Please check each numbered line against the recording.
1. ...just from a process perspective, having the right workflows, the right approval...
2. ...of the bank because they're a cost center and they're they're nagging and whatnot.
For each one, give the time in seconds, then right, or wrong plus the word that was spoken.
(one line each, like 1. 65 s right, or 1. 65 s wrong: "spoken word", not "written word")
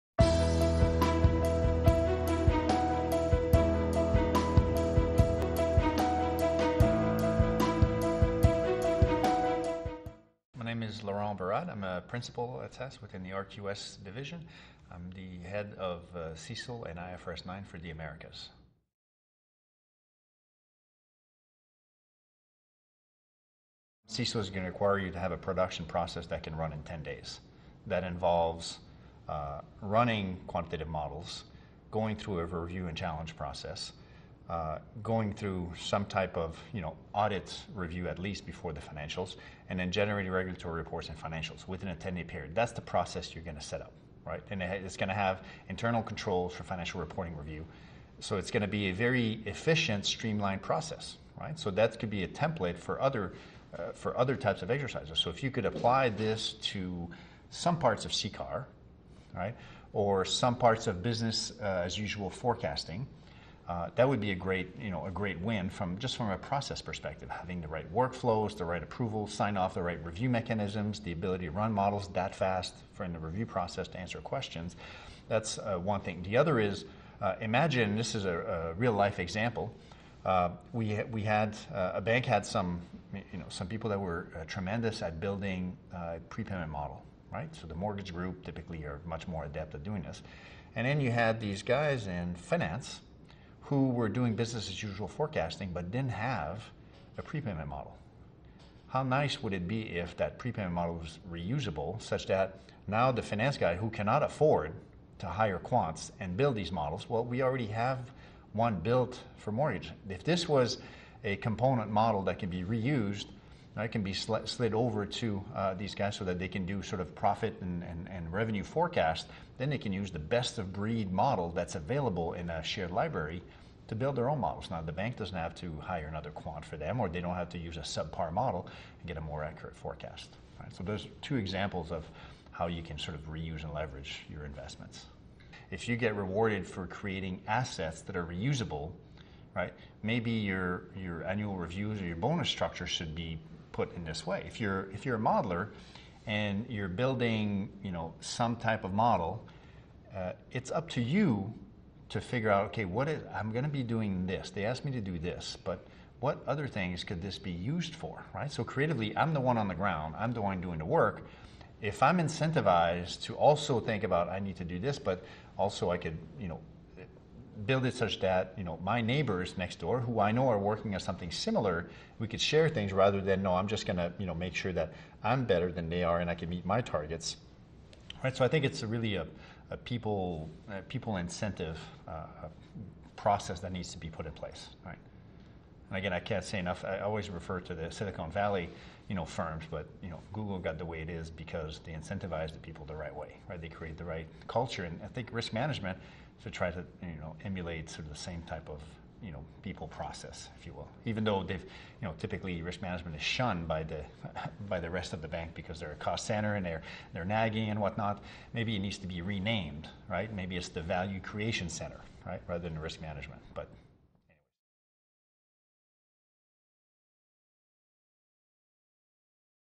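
1. 65 s right
2. 205 s right.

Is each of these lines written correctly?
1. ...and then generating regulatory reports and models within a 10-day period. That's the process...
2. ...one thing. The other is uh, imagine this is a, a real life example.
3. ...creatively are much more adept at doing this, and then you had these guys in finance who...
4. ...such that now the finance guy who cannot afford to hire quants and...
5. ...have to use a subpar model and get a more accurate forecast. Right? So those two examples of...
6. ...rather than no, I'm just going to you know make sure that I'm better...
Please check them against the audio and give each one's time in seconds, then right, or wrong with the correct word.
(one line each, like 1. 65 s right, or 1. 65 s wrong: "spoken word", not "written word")
1. 39 s wrong: "financials", not "models"
2. 75 s right
3. 88 s wrong: "typically", not "creatively"
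4. 102 s right
5. 127 s right
6. 172 s right.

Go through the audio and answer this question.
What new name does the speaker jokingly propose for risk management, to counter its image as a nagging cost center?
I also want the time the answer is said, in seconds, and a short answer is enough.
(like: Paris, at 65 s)
value creation center, at 210 s.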